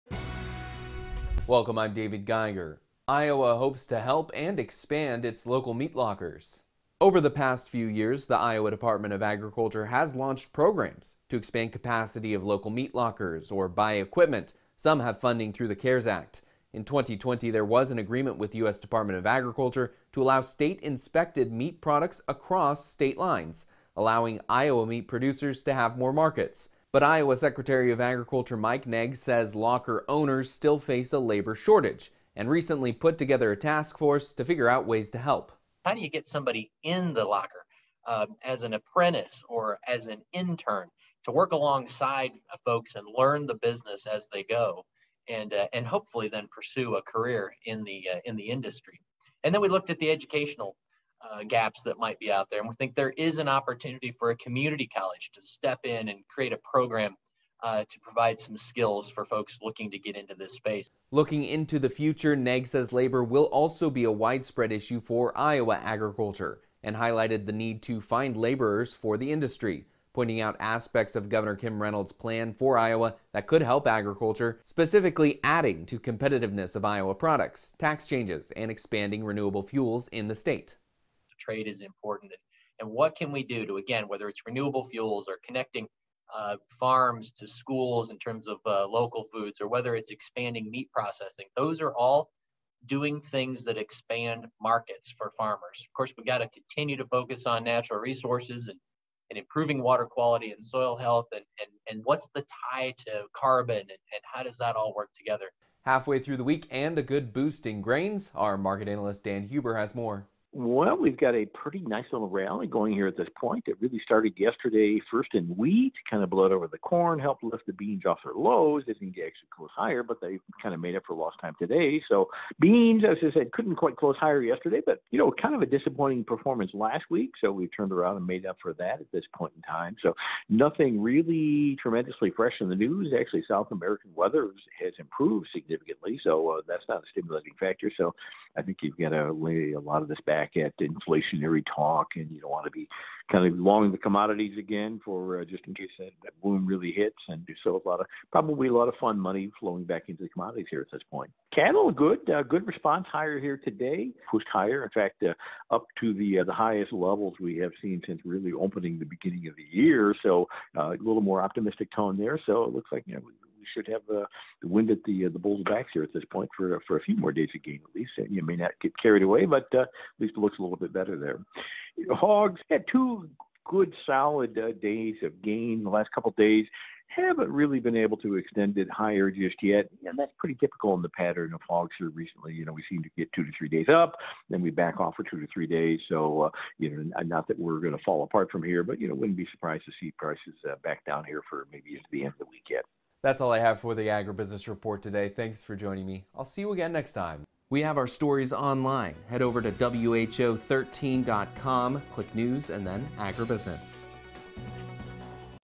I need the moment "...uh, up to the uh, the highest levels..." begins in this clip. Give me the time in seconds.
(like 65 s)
155 s.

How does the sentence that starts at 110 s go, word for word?
Well, we've got a pretty nice little rally going here at this point.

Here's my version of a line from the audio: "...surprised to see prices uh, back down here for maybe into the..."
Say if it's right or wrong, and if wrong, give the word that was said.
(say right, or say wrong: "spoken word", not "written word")
right.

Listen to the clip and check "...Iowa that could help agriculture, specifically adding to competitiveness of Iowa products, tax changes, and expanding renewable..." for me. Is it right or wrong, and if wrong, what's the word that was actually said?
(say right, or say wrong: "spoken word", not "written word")
right.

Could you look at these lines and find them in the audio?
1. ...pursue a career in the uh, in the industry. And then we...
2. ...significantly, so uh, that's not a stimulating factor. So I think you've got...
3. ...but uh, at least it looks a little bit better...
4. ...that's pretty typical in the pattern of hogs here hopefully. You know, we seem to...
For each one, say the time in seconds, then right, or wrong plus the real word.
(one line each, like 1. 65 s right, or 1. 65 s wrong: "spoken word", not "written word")
1. 46 s right
2. 135 s right
3. 169 s right
4. 180 s wrong: "recently", not "hopefully".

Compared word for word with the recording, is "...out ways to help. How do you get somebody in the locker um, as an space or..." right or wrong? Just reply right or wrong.
wrong.